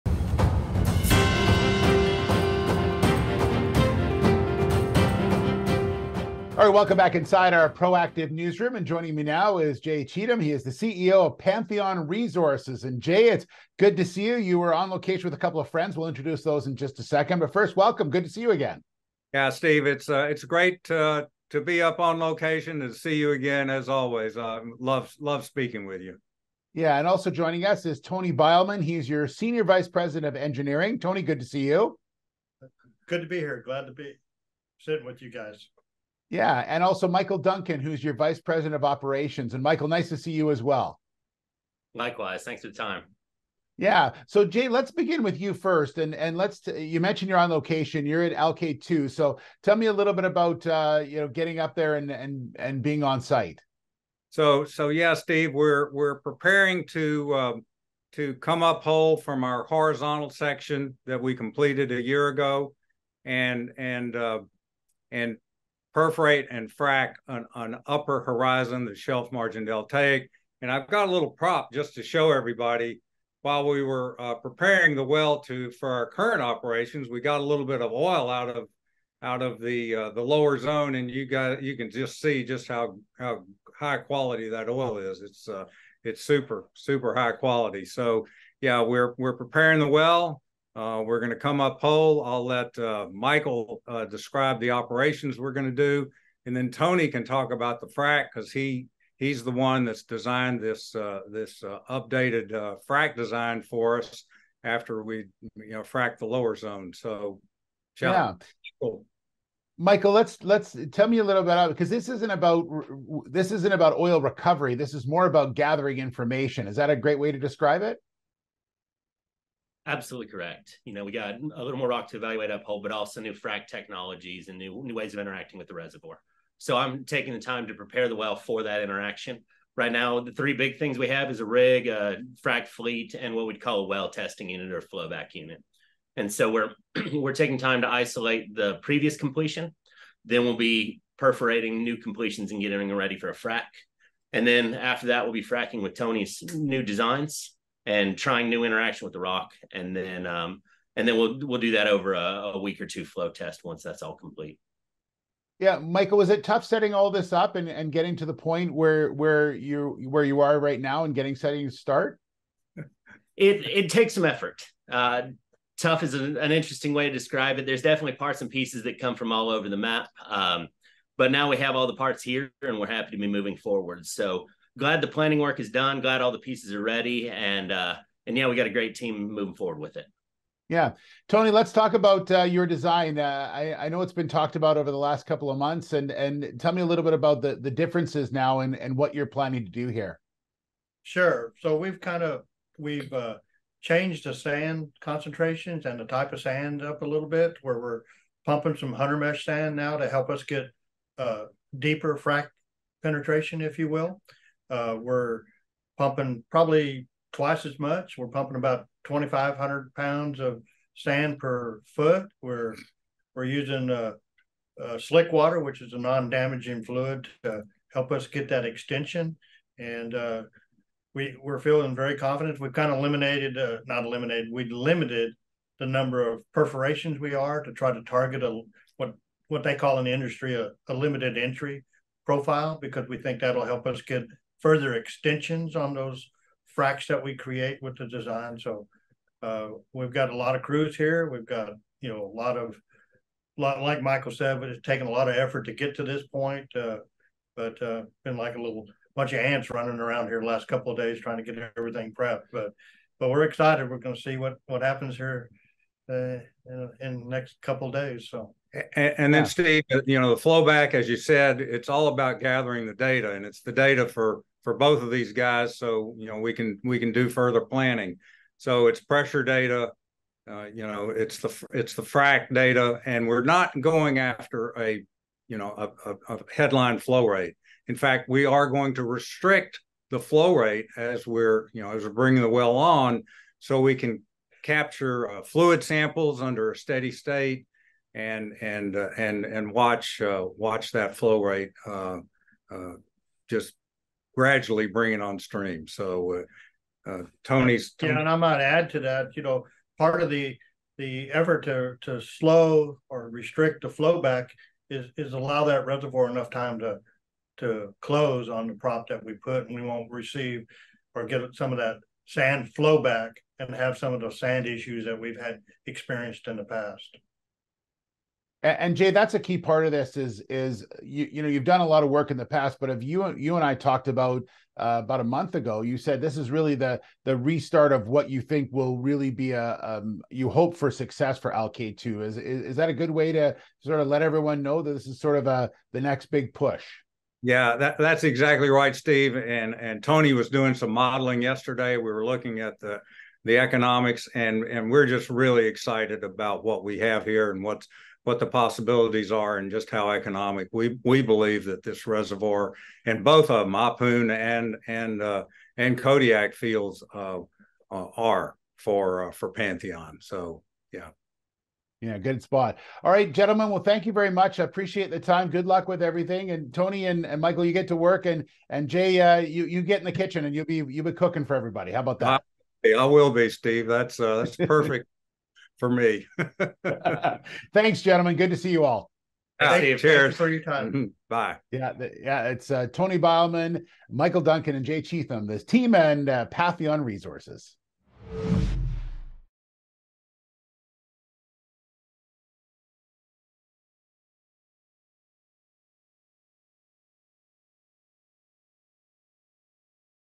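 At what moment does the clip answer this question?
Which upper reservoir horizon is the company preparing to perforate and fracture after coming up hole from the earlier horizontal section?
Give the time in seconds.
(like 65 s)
68 s.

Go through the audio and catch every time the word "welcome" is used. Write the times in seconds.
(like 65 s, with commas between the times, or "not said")
6 s, 17 s.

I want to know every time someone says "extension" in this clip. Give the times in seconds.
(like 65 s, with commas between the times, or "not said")
218 s, 234 s.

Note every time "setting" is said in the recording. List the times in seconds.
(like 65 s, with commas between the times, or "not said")
156 s, 161 s.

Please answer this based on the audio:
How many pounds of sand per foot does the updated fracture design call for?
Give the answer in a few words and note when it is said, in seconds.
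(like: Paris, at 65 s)
2,500, at 209 s.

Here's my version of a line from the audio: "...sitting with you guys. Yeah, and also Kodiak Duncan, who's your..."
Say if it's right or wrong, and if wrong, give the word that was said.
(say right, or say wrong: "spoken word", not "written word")
wrong: "Michael", not "Kodiak".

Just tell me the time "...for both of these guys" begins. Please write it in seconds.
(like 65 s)
264 s.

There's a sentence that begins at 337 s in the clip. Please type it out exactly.
Yeah, that, that's exactly right, Steve.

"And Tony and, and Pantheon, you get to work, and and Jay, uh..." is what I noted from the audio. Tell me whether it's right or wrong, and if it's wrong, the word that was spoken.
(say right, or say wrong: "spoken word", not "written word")
wrong: "Michael", not "Pantheon".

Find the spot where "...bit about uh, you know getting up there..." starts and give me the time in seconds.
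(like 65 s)
50 s.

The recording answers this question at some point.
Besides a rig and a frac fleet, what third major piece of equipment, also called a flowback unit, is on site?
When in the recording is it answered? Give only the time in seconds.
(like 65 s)
133 s.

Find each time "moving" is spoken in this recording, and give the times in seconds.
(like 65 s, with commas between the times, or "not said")
173 s, 179 s.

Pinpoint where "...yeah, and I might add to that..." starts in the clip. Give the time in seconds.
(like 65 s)
298 s.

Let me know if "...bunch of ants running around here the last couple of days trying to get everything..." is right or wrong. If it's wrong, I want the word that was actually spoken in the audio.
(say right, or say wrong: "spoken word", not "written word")
right.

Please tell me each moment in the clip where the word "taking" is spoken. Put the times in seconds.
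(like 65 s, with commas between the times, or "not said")
127 s, 137 s.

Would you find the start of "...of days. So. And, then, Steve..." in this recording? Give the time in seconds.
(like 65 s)
257 s.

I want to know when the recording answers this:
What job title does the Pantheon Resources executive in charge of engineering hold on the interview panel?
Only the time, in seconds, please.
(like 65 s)
29 s.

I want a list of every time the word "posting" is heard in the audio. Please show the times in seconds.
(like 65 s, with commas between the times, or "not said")
not said.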